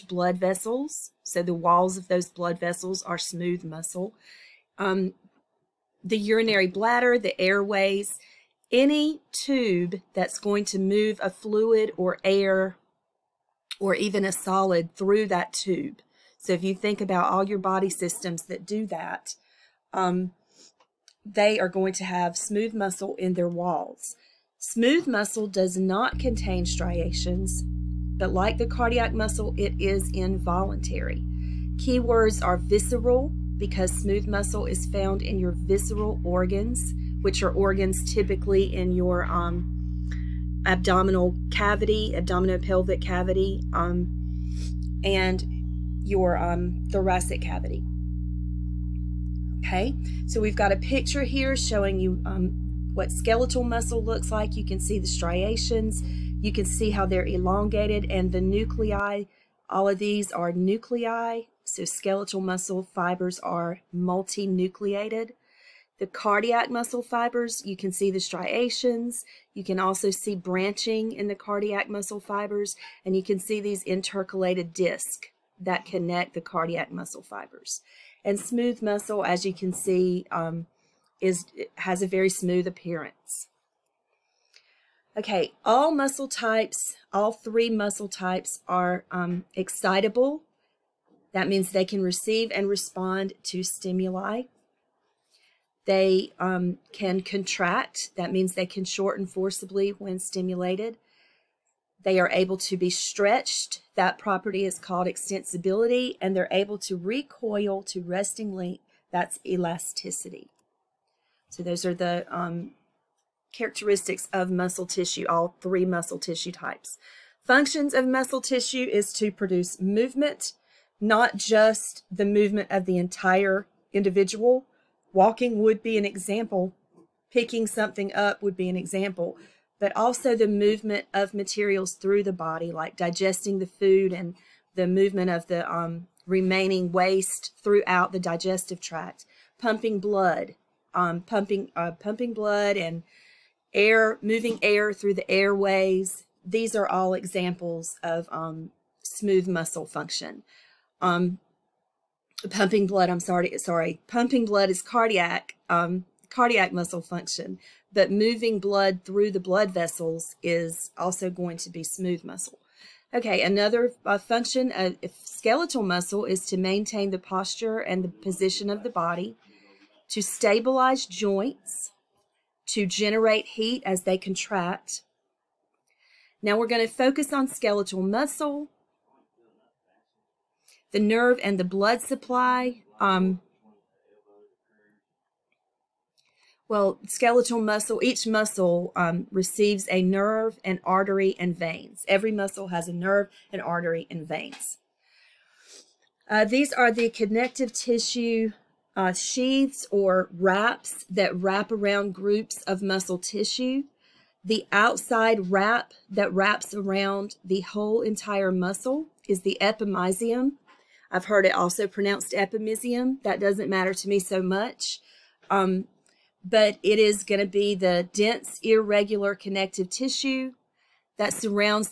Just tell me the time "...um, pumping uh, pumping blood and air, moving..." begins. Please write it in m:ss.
2:20.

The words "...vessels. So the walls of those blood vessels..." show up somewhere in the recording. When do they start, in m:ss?
0:00.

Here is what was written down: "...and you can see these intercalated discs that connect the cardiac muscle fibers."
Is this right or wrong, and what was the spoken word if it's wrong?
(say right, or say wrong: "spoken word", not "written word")
right.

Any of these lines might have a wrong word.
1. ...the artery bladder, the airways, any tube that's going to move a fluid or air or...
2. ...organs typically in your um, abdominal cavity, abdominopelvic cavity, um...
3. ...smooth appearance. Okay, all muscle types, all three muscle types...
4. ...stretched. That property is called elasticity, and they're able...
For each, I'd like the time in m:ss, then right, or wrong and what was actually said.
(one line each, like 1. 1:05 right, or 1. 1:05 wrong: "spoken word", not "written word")
1. 0:06 wrong: "urinary", not "artery"
2. 0:37 right
3. 1:22 right
4. 1:42 wrong: "extensibility", not "elasticity".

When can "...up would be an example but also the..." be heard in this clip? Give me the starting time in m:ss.
2:08.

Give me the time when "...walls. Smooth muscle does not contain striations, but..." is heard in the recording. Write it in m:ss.
0:23.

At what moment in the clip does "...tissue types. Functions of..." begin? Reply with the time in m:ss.
1:56.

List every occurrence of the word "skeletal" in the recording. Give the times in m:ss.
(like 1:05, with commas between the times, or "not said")
0:53, 1:01, 2:45, 2:57, 3:07.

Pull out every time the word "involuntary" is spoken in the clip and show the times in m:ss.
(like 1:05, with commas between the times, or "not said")
0:30.